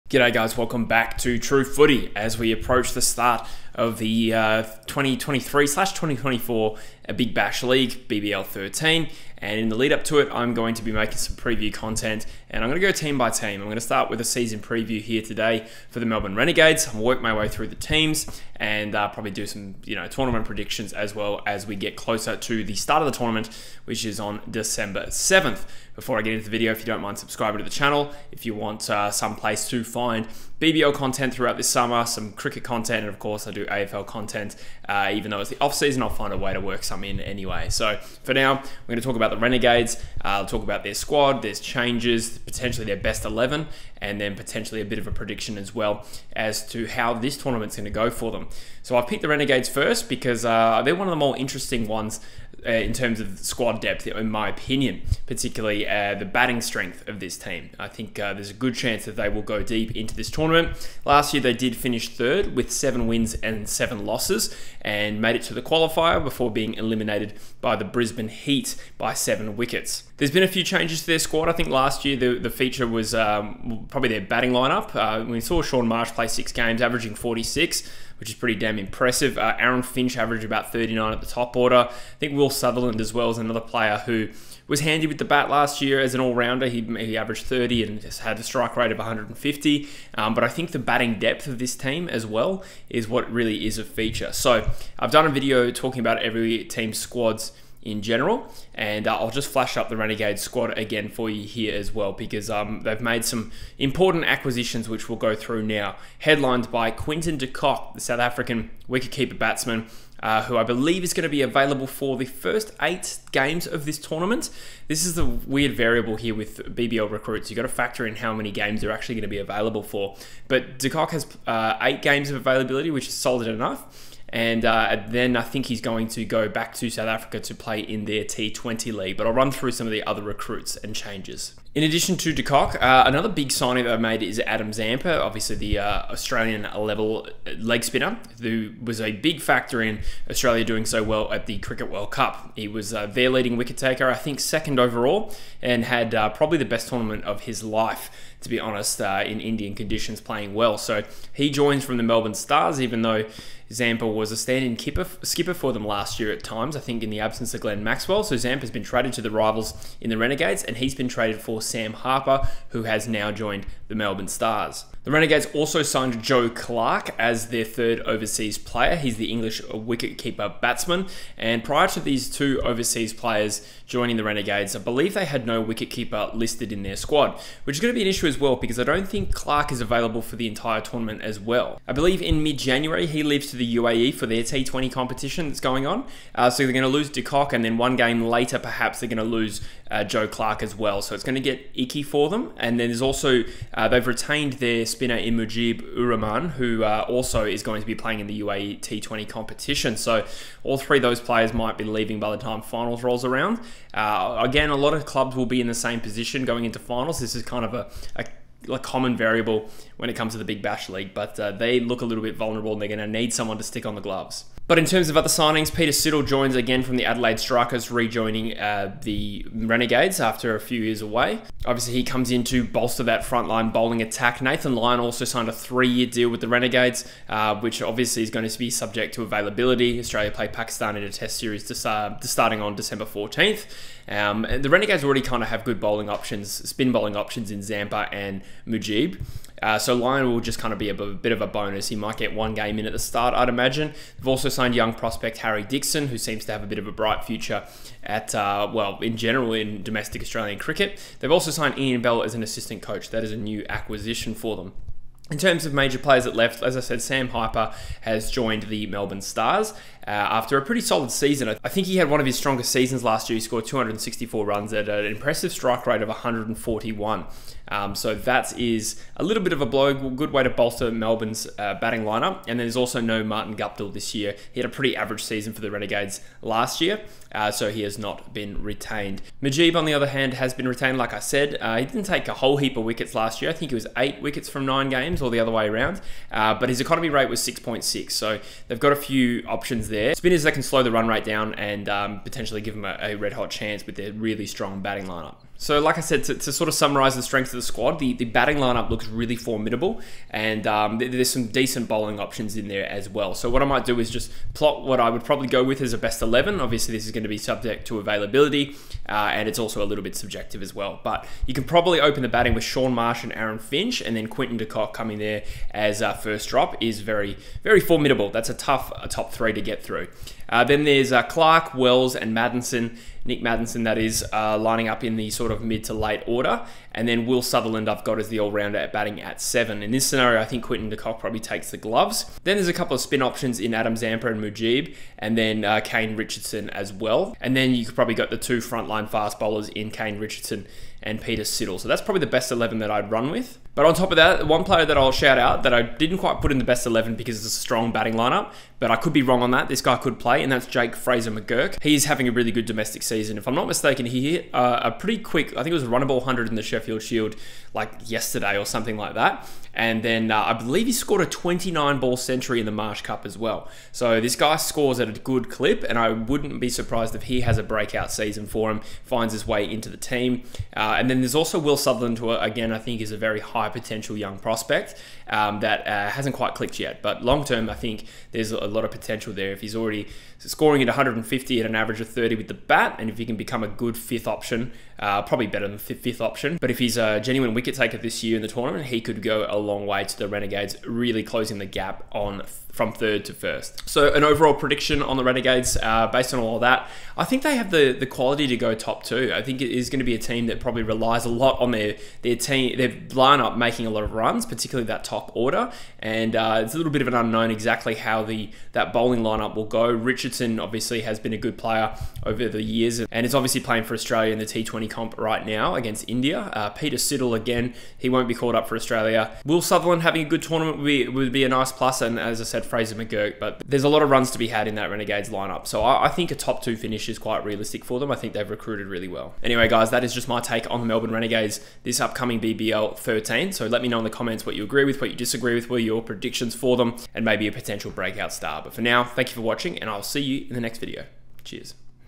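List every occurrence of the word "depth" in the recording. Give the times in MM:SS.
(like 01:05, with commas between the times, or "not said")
00:53, 01:31.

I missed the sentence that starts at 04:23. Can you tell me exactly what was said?
He scored 264 runs at an impressive strike rate of 141.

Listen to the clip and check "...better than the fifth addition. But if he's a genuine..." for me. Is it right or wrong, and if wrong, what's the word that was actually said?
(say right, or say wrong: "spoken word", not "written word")
wrong: "option", not "addition".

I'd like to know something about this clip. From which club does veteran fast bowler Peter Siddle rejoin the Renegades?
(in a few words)
Adelaide Strikers.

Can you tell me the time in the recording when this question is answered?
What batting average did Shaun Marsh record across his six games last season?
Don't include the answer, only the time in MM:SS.
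01:16.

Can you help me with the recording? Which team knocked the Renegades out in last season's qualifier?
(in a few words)
Brisbane Heat.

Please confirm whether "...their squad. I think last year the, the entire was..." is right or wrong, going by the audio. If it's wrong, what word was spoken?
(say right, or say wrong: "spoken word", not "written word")
wrong: "feature", not "entire".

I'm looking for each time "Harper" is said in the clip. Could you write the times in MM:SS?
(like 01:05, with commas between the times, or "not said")
02:41, 04:17.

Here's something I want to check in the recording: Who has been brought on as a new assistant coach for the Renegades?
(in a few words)
Ian Bell.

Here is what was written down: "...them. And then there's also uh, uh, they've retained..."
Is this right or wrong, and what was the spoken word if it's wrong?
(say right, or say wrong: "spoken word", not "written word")
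right.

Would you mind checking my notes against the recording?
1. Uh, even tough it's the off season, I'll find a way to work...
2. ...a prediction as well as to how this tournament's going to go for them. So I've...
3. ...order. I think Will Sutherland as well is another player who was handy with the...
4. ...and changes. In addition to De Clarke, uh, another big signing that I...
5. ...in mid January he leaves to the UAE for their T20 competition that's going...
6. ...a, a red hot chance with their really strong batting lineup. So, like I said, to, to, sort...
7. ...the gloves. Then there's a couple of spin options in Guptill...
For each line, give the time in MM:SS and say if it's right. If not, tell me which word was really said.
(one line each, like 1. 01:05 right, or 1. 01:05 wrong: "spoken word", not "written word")
1. 00:34 wrong: "though", not "tough"
2. 00:45 right
3. 01:21 right
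4. 02:10 wrong: "Kock", not "Clarke"
5. 03:02 right
6. 04:52 right
7. 05:31 wrong: "Adam", not "Guptill".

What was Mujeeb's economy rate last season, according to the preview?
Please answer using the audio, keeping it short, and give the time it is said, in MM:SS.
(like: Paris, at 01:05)
6.6, at 04:47.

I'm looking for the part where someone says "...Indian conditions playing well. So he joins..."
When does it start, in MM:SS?
02:29.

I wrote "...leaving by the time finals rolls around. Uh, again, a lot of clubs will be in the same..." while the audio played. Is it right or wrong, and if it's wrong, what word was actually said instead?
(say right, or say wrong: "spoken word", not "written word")
right.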